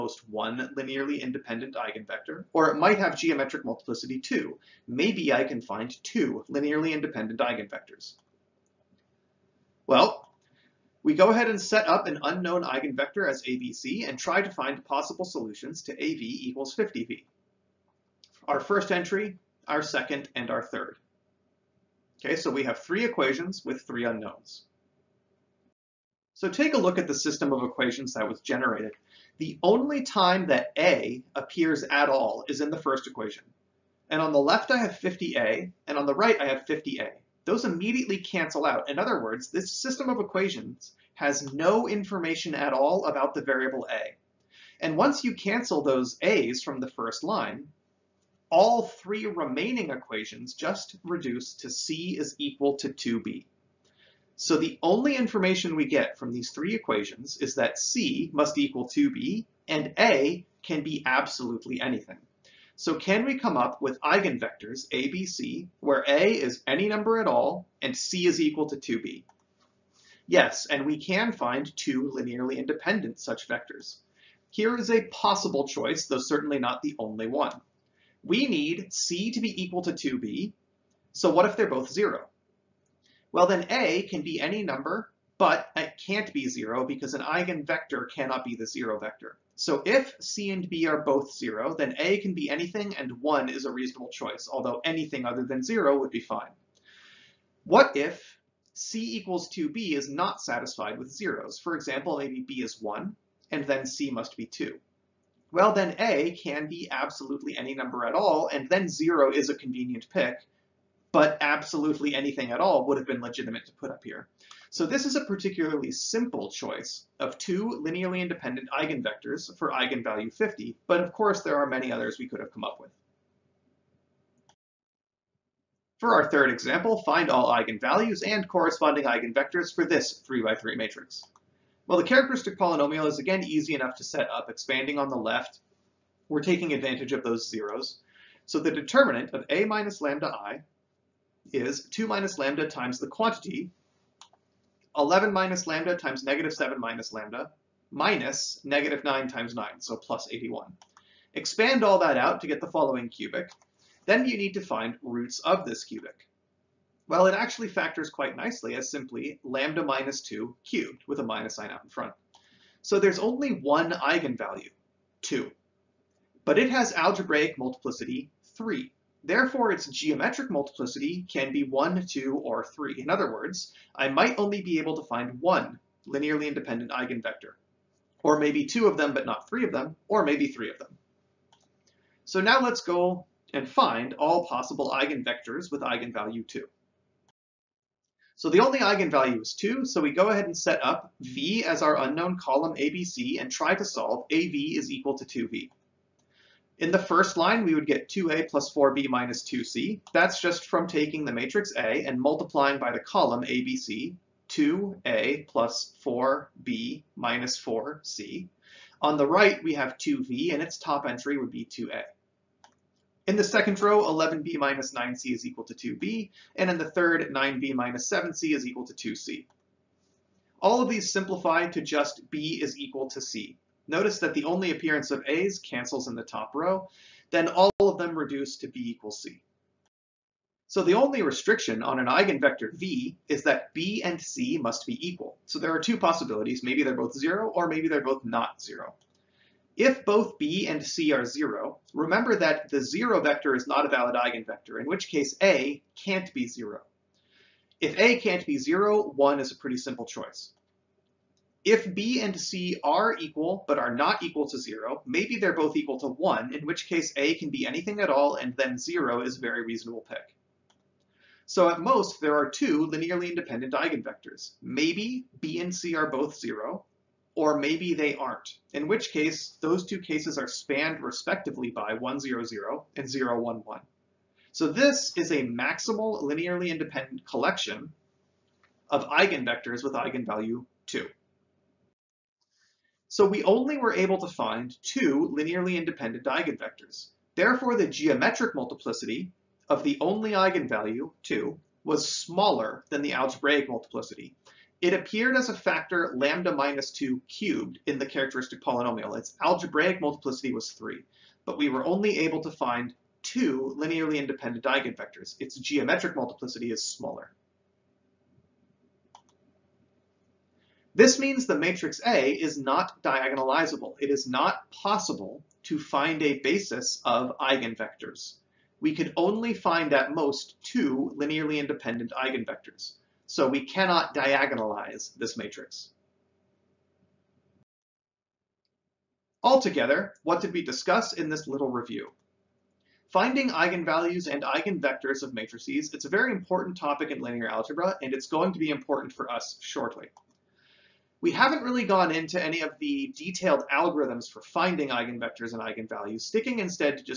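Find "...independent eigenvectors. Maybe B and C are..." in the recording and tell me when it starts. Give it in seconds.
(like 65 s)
263 s.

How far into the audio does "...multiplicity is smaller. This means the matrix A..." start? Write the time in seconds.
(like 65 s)
306 s.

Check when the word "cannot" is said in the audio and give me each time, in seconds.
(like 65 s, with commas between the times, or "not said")
88 s, 323 s.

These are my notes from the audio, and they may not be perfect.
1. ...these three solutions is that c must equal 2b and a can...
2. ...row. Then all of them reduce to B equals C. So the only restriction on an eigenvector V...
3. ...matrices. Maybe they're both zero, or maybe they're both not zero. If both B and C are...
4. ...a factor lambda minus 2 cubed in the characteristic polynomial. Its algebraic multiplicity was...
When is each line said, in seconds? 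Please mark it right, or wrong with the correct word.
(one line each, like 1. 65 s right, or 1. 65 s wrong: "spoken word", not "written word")
1. 56 s wrong: "equations", not "solutions"
2. 226 s right
3. 235 s wrong: "possibilities", not "matrices"
4. 295 s right.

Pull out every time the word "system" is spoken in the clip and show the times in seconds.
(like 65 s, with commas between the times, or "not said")
27 s, 39 s.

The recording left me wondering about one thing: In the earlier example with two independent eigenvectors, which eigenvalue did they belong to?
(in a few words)
50.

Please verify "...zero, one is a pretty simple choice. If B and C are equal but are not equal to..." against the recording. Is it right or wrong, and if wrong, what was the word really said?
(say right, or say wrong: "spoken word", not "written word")
right.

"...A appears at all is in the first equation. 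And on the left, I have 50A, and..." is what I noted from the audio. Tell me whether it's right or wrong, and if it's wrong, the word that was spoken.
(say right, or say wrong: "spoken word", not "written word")
right.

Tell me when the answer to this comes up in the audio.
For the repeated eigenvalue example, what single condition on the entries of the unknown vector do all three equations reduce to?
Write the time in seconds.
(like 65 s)
222 s.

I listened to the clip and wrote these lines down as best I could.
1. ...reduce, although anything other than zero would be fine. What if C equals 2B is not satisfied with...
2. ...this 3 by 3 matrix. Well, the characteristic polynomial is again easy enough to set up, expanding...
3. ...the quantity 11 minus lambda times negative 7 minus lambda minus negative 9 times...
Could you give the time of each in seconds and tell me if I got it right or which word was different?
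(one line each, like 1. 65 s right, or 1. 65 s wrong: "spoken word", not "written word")
1. 94 s wrong: "choice", not "reduce"
2. 129 s right
3. 142 s right.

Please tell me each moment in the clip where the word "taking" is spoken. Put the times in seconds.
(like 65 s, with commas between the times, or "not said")
136 s, 200 s.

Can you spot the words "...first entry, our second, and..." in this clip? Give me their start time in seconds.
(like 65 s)
18 s.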